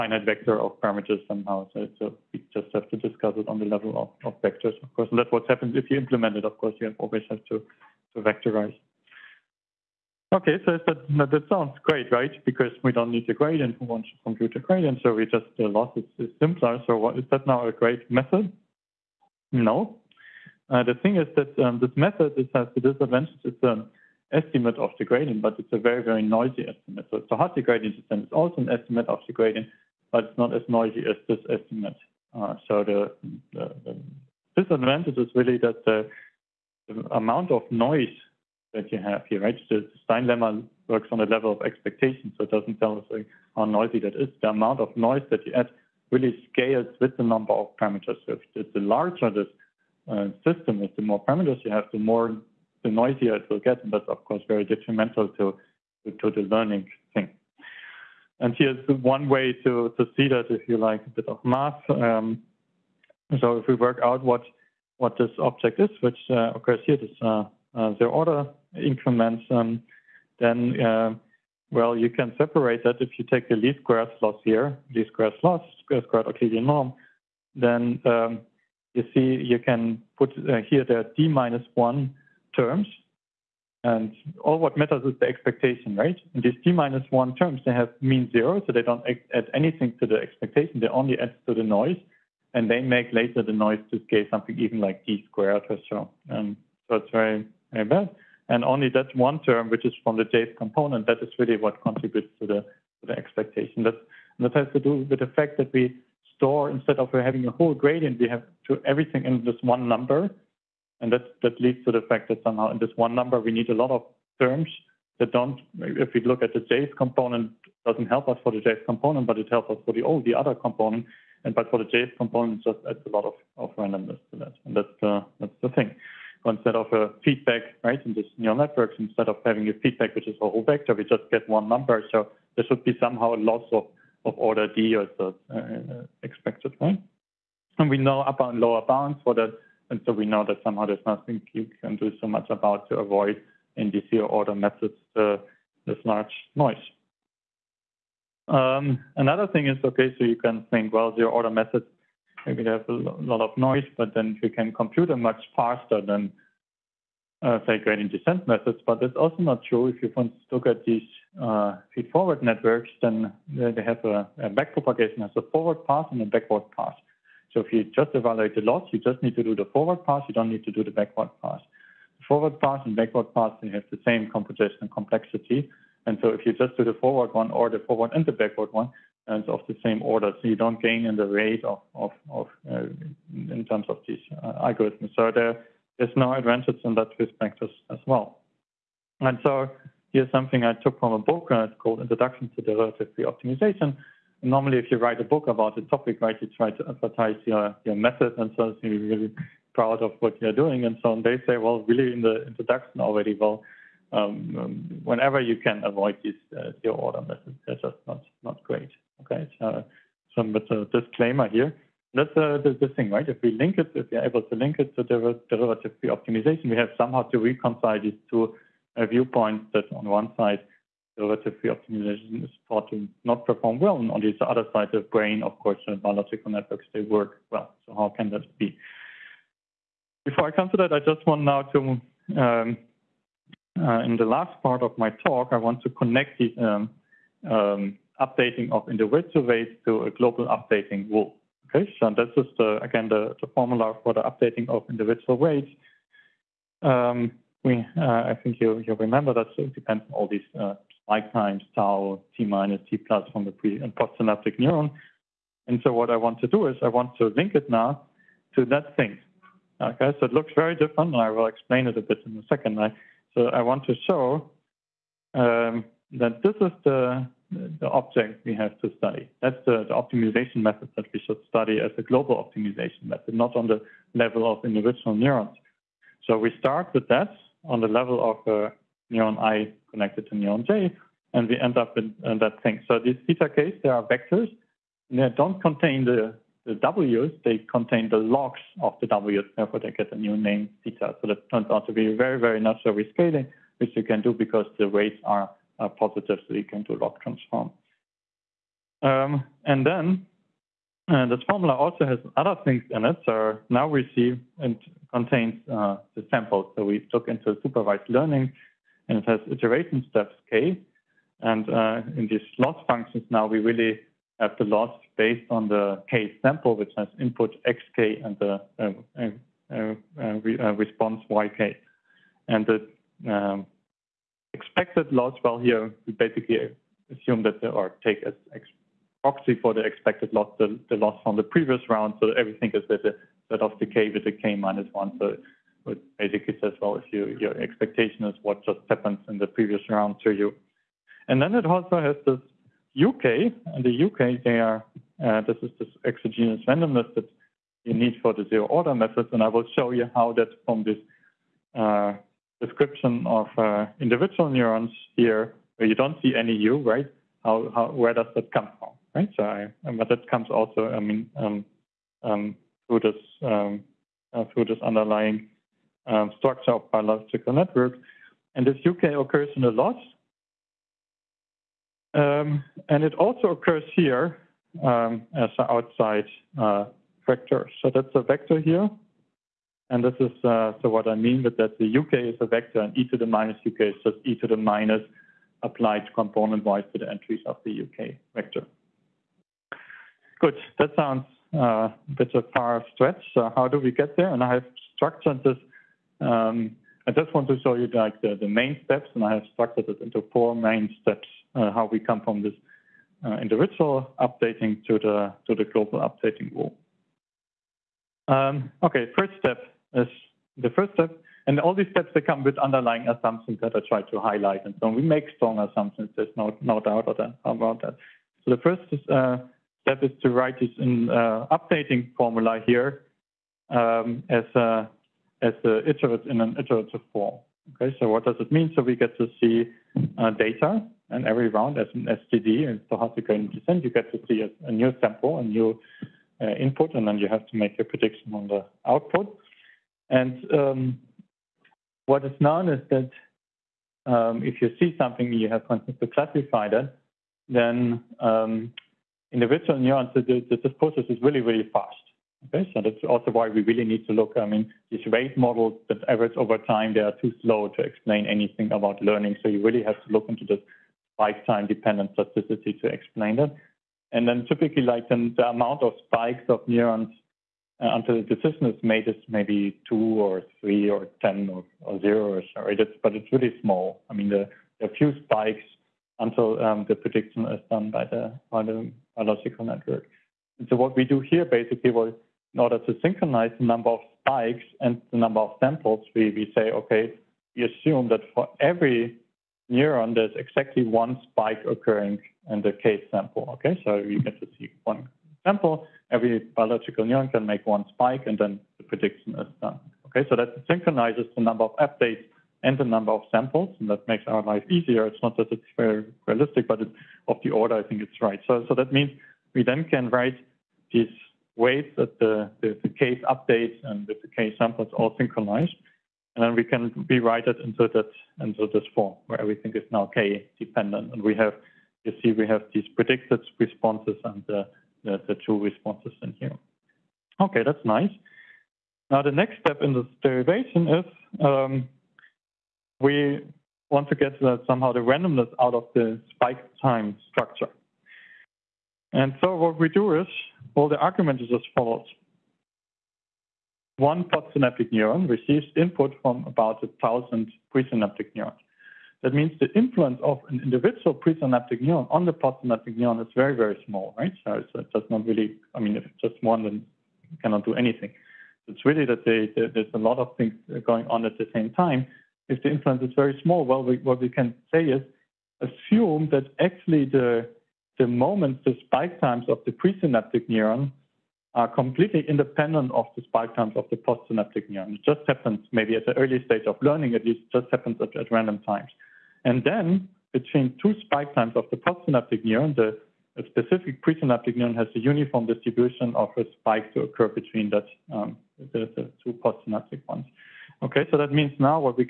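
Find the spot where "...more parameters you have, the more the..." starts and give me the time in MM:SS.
00:51.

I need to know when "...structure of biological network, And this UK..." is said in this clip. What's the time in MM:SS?
06:06.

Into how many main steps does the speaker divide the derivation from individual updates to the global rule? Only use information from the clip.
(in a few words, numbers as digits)
4.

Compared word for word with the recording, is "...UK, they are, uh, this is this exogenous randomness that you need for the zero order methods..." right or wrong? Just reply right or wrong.
right.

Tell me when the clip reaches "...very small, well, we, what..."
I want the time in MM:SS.
09:23.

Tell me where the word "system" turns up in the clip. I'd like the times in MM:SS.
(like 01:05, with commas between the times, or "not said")
00:27, 00:50.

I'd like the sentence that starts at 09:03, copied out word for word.
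One postsynaptic neuron receives input from about a thousand presynaptic neurons.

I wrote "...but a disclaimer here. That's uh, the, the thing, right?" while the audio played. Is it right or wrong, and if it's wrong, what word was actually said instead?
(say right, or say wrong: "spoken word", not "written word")
right.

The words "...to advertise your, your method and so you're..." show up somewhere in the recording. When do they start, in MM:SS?
03:16.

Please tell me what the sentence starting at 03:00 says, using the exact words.
So you don't gain in the rate of, of, of uh, in terms of these uh, algorithms.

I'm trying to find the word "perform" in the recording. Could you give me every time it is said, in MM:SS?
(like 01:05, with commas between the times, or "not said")
03:43.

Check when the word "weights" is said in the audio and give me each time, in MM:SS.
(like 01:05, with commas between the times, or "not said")
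03:59, 04:05.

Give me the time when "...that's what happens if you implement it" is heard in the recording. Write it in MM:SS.
00:05.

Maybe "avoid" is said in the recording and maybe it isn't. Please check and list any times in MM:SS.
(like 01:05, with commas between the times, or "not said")
02:22, 03:25.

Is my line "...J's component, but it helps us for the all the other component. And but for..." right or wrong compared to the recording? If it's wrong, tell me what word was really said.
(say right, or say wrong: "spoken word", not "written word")
right.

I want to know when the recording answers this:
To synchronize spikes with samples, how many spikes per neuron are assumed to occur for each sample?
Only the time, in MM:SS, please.
08:10.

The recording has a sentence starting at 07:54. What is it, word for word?
I mean, there a few spikes until um, the prediction is done by the, by the biological network.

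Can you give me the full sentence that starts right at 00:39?
The Stein lemma works on the level of expectation, so it doesn't tell us like, how noisy that is.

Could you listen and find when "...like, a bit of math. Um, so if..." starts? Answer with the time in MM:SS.
01:00.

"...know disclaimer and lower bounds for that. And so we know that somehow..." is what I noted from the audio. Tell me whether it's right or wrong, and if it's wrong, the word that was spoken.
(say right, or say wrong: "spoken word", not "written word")
wrong: "upper", not "disclaimer".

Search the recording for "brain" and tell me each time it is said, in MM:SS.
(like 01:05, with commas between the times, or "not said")
03:44.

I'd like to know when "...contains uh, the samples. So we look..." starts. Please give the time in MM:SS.
05:05.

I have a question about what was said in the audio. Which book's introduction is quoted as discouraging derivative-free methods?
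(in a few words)
Introduction to Derivative Optimization.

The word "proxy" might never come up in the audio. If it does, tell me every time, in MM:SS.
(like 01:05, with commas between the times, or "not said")
05:29.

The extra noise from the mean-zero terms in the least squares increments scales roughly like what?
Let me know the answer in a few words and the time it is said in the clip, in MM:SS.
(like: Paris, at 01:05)
d squared, at 01:35.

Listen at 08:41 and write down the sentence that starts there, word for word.
And we have you see we have these predicted responses and the, the, the true responses in here.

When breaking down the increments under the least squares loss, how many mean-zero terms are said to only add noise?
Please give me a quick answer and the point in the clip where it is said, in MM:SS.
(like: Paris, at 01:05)
d minus one, at 01:21.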